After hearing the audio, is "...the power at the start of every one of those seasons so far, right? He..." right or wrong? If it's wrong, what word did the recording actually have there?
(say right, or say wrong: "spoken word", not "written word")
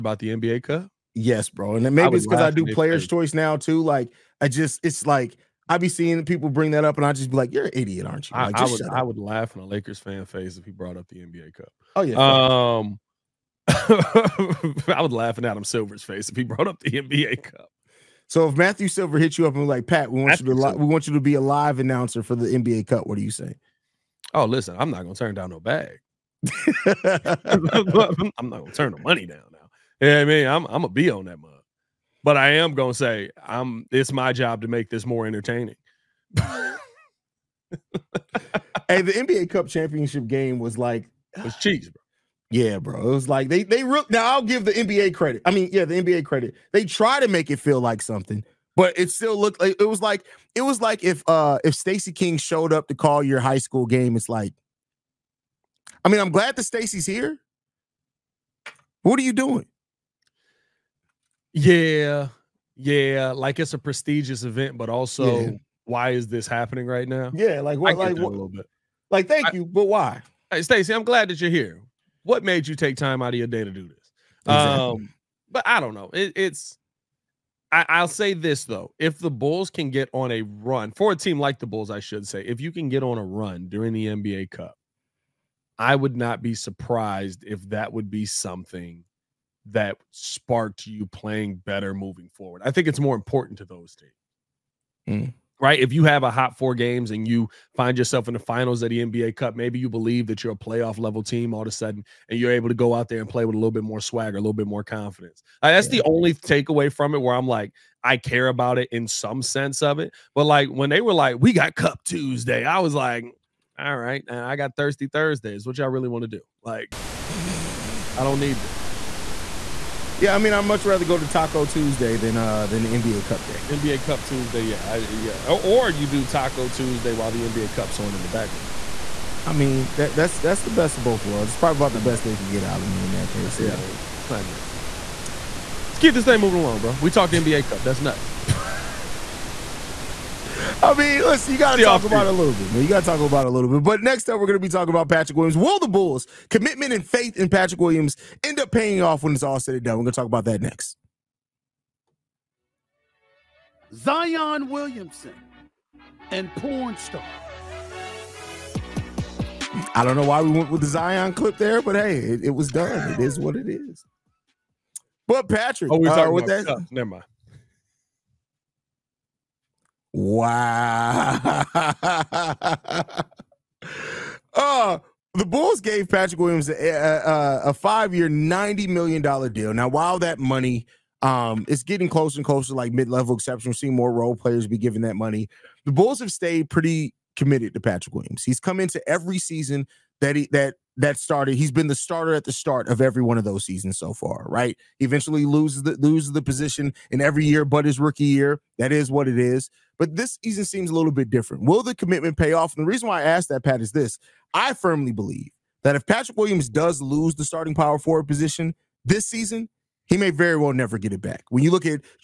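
wrong: "starter", not "power".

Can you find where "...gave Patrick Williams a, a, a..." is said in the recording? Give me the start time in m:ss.
2:55.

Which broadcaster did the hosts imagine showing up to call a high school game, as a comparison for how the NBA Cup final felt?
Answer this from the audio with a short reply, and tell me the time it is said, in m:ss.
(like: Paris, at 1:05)
Stacey King, at 0:51.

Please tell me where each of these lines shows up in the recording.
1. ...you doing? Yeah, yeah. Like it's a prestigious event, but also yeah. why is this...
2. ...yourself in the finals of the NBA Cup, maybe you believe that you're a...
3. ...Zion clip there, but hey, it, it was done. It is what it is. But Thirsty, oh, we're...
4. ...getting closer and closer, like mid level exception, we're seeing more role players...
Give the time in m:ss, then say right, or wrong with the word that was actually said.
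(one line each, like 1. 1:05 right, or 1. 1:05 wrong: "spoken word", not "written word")
1. 0:59 right
2. 1:37 right
3. 2:40 wrong: "Patrick", not "Thirsty"
4. 3:01 right.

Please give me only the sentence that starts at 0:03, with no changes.
Like I just it's like I be seeing people bring that up and I just be like, You're an idiot, aren't you?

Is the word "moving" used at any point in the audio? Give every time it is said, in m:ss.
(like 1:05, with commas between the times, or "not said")
1:31, 2:16.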